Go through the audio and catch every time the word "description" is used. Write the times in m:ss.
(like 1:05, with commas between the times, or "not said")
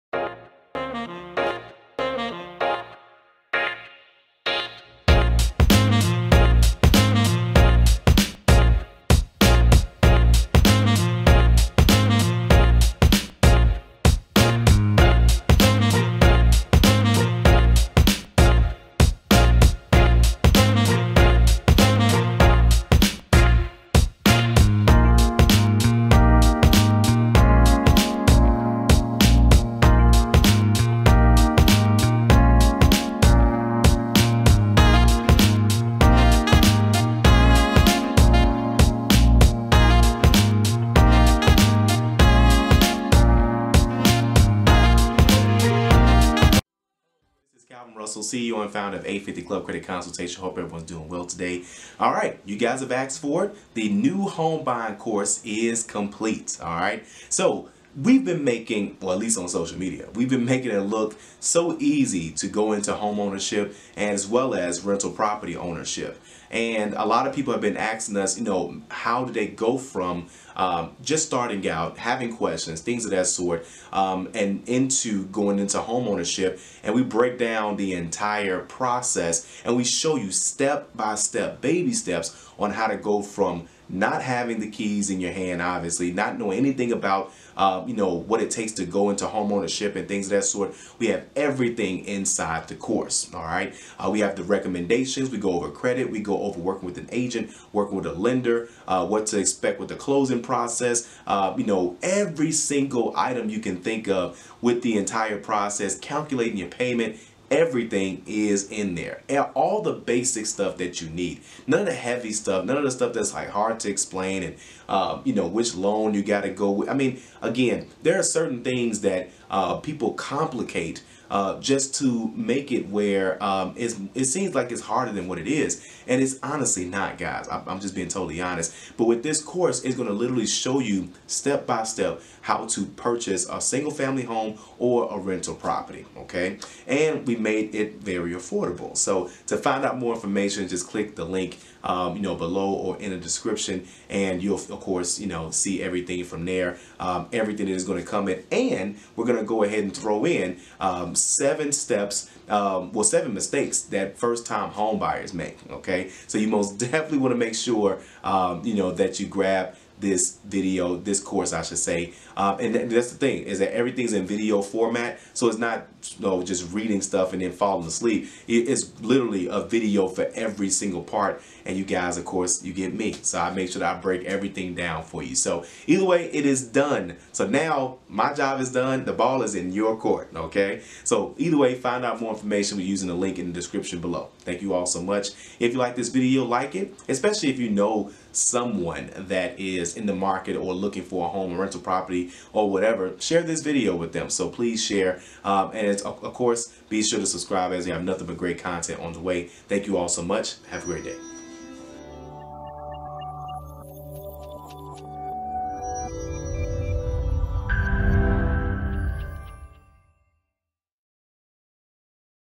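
2:23, 3:03.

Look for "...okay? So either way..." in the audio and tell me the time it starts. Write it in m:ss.
3:00.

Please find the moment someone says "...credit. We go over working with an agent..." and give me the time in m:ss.
1:35.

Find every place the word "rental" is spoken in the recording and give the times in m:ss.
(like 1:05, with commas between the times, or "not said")
1:04, 2:15, 3:11.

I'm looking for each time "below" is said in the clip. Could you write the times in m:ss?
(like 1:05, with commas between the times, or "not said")
2:22, 3:04.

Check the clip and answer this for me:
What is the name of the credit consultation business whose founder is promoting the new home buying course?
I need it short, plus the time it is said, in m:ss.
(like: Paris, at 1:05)
850 Club Credit Consultation, at 0:49.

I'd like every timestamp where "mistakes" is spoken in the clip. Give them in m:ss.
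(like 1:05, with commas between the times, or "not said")
2:33.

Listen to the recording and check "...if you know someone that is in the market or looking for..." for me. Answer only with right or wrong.
right.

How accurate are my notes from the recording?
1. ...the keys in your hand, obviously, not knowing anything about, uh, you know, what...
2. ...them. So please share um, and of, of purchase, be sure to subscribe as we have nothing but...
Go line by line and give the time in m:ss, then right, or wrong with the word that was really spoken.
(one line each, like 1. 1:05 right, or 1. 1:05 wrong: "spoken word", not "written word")
1. 1:24 right
2. 3:14 wrong: "course", not "purchase".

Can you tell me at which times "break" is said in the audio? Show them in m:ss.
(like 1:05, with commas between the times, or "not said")
1:17, 2:53.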